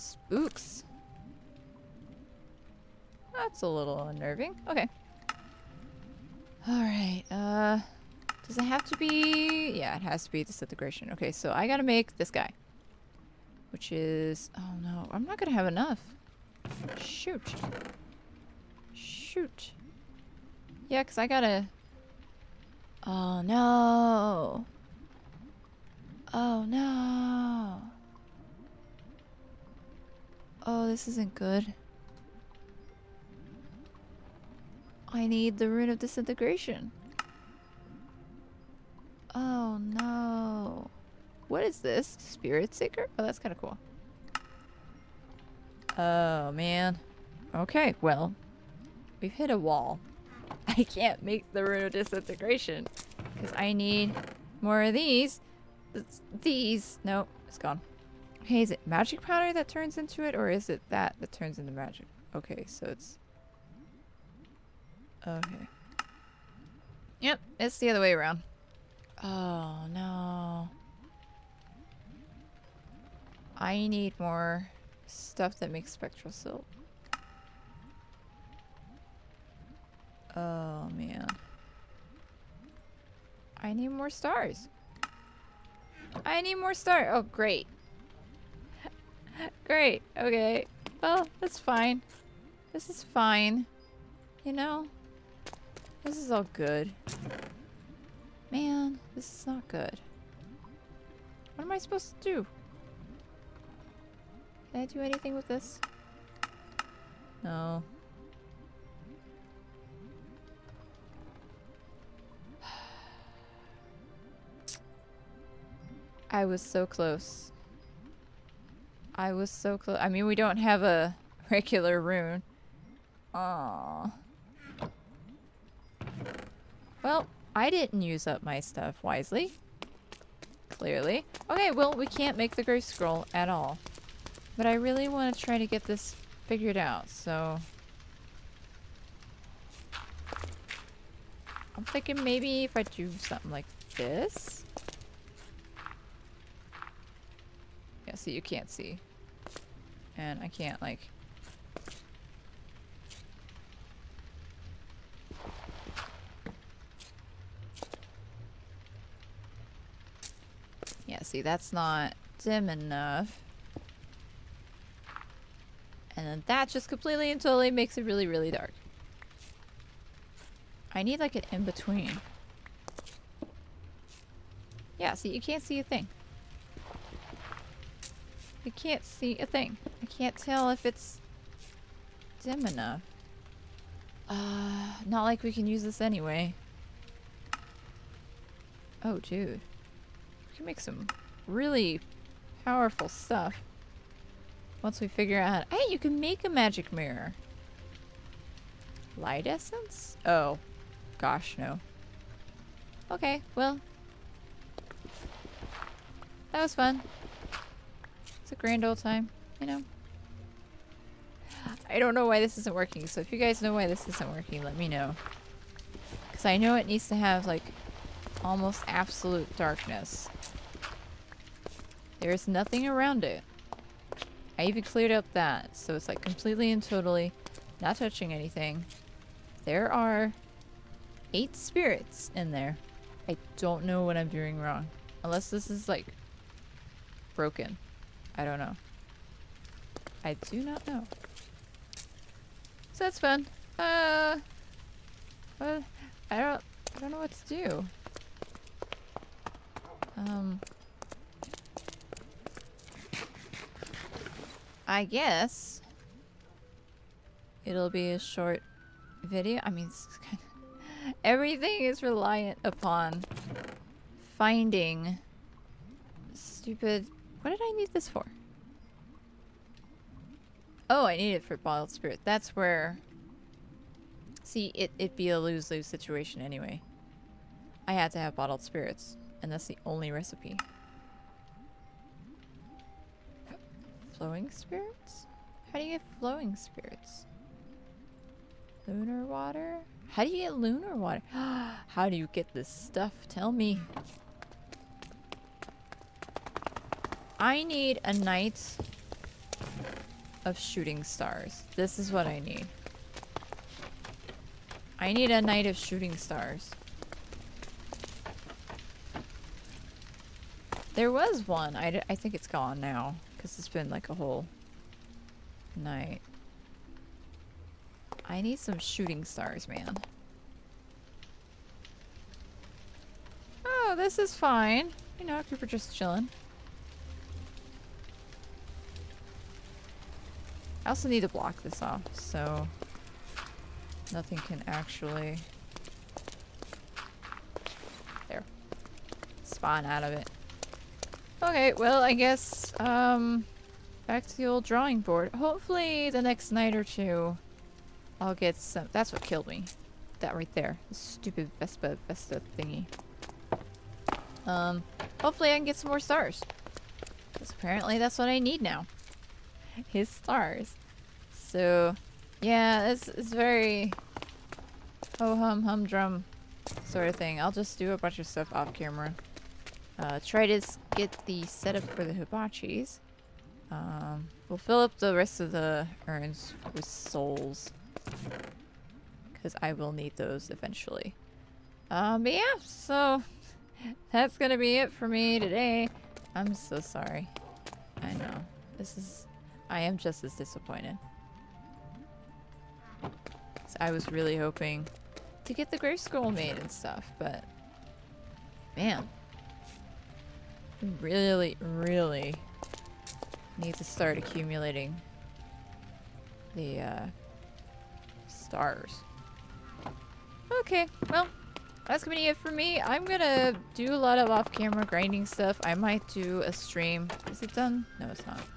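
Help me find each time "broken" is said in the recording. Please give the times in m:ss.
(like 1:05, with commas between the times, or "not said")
3:57.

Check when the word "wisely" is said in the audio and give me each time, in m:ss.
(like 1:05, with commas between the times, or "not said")
2:09.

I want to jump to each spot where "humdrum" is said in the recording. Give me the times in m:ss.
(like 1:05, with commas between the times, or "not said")
6:05.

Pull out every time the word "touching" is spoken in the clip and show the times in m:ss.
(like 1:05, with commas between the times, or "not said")
3:47.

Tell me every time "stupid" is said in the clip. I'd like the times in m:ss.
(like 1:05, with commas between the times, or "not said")
4:26, 5:50.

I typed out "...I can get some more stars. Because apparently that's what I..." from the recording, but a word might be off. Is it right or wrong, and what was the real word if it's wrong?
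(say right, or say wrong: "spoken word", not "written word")
right.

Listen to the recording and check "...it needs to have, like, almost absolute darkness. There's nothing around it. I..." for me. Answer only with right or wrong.
right.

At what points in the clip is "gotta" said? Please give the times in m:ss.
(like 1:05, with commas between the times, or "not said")
0:11, 0:21.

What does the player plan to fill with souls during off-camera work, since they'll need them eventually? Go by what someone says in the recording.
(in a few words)
The urns.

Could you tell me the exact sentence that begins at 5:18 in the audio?
I need some shooting stars, man.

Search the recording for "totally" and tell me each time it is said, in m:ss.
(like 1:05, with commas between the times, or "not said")
2:47, 3:46.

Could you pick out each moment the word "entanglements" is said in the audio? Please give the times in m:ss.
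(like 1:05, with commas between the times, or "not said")
not said.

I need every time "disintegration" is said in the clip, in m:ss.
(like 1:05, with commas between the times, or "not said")
0:10, 0:35, 0:51.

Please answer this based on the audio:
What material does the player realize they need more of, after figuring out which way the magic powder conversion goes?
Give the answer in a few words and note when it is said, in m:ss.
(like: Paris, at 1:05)
Spectral silt, at 1:15.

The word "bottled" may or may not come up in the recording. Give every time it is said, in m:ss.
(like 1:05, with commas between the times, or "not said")
4:31, 4:38.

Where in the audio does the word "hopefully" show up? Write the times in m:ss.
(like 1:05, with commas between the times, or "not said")
5:45, 5:55.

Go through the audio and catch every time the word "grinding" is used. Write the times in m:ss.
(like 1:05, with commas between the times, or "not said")
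6:54.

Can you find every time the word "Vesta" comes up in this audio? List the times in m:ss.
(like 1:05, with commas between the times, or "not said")
5:52.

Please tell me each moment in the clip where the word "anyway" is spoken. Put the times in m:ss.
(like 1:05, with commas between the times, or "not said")
3:05, 4:36.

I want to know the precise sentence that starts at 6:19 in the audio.
Because I will need those eventually.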